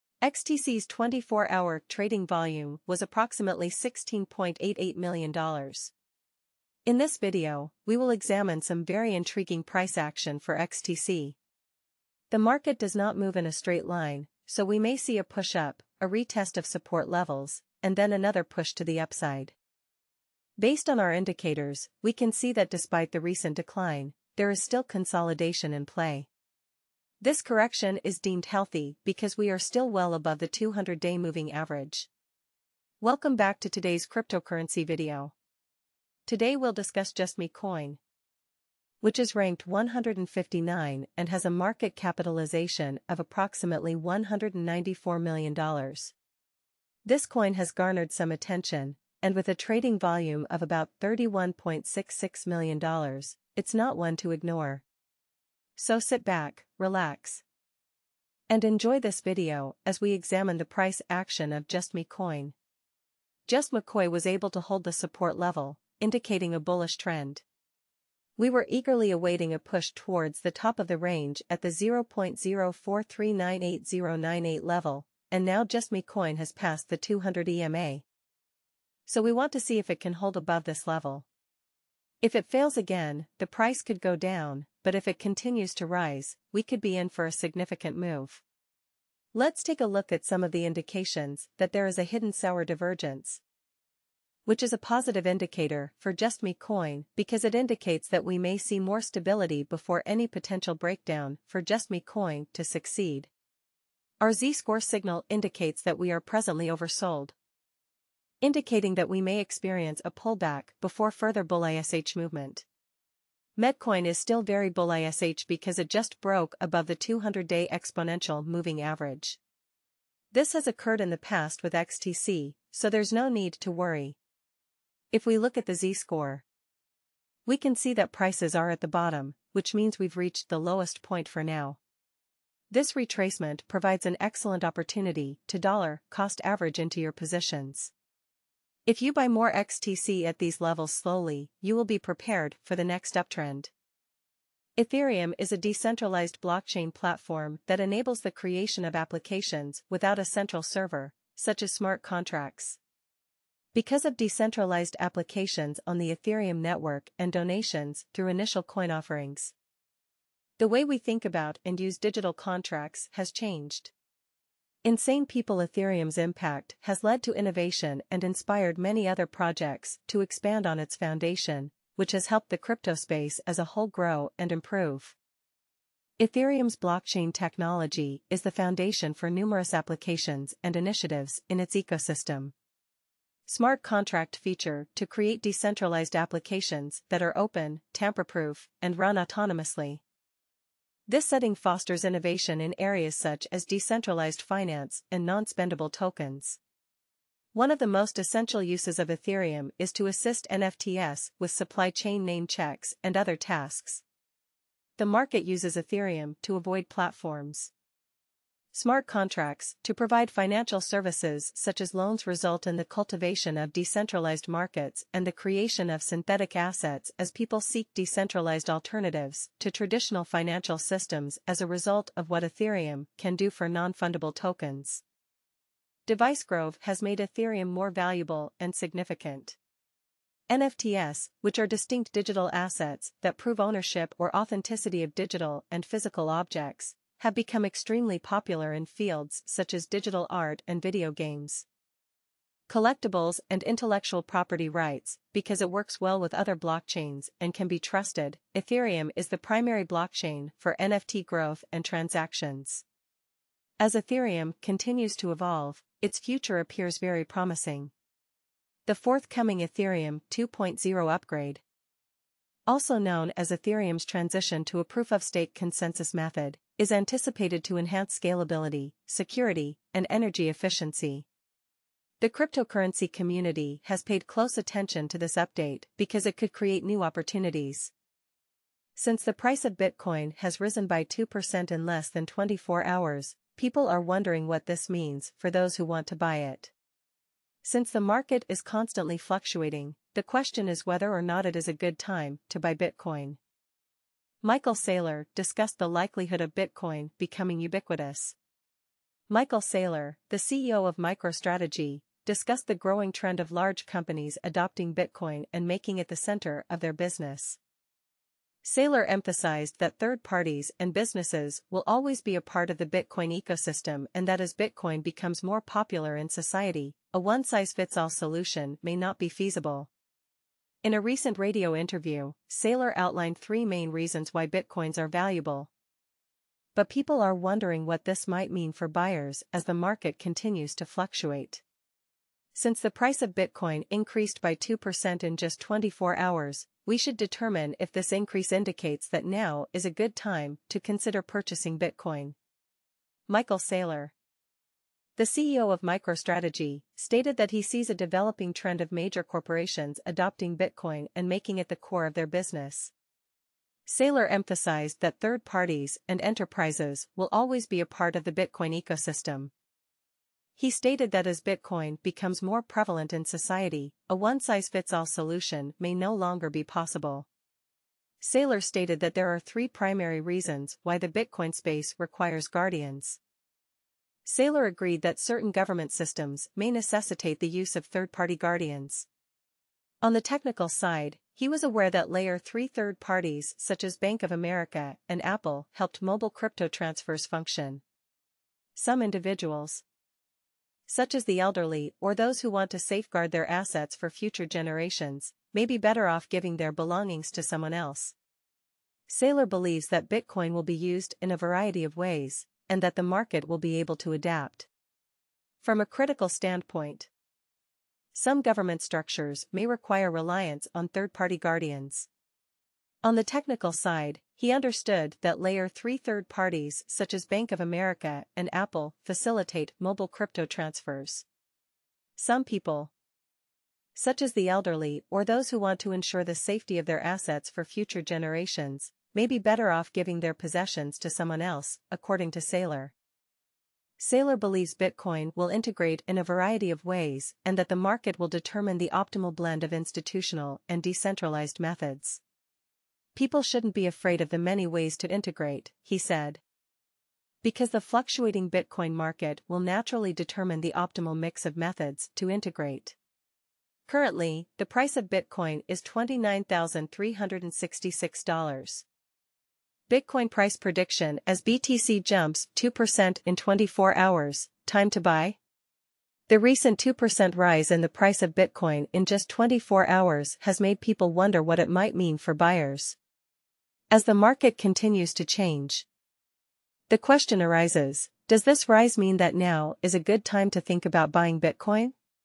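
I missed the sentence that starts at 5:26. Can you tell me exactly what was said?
But people are wondering what this might mean for buyers as the market continues to fluctuate.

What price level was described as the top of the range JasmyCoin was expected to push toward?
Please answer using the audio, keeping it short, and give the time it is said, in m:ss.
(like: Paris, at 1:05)
0.04398098, at 1:11.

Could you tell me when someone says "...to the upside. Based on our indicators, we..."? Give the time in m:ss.
0:18.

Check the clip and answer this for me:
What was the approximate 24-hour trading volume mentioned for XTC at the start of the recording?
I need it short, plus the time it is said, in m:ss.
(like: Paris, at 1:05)
$16.88 million, at 0:03.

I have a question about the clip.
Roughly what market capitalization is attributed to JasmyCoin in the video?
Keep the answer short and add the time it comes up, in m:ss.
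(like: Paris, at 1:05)
$194 million, at 0:43.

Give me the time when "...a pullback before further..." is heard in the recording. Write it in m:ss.
1:50.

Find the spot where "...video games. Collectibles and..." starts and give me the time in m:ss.
4:00.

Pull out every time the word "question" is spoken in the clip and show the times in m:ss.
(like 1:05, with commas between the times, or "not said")
4:50, 7:56.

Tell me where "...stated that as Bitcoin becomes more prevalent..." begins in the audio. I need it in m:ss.
6:00.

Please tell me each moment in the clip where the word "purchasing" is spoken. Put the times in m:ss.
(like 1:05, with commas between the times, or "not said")
5:41.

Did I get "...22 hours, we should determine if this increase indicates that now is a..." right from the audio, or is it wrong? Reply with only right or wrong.
wrong.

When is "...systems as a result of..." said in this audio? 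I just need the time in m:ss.
3:40.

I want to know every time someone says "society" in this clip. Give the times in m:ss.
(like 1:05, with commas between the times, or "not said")
5:16, 6:03.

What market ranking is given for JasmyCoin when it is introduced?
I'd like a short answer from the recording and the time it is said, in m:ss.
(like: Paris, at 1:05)
159, at 0:39.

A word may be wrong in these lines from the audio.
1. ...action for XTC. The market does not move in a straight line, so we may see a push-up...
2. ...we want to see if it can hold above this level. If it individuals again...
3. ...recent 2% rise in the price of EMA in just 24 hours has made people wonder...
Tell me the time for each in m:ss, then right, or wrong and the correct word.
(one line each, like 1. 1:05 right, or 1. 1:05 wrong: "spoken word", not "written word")
1. 0:09 right
2. 1:19 wrong: "fails", not "individuals"
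3. 7:46 wrong: "Bitcoin", not "EMA".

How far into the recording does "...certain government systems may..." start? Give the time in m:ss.
6:15.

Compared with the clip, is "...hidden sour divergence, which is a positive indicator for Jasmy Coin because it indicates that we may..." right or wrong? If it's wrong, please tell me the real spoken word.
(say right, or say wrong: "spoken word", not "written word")
right.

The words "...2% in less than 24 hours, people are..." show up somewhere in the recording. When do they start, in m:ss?
4:41.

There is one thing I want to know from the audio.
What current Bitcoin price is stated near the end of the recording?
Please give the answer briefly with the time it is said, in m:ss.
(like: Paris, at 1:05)
$29,366, at 7:35.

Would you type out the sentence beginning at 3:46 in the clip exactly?
DeviceGrove has made Ethereum more valuable and significant.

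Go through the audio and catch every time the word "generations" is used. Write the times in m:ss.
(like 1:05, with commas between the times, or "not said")
6:34, 7:08.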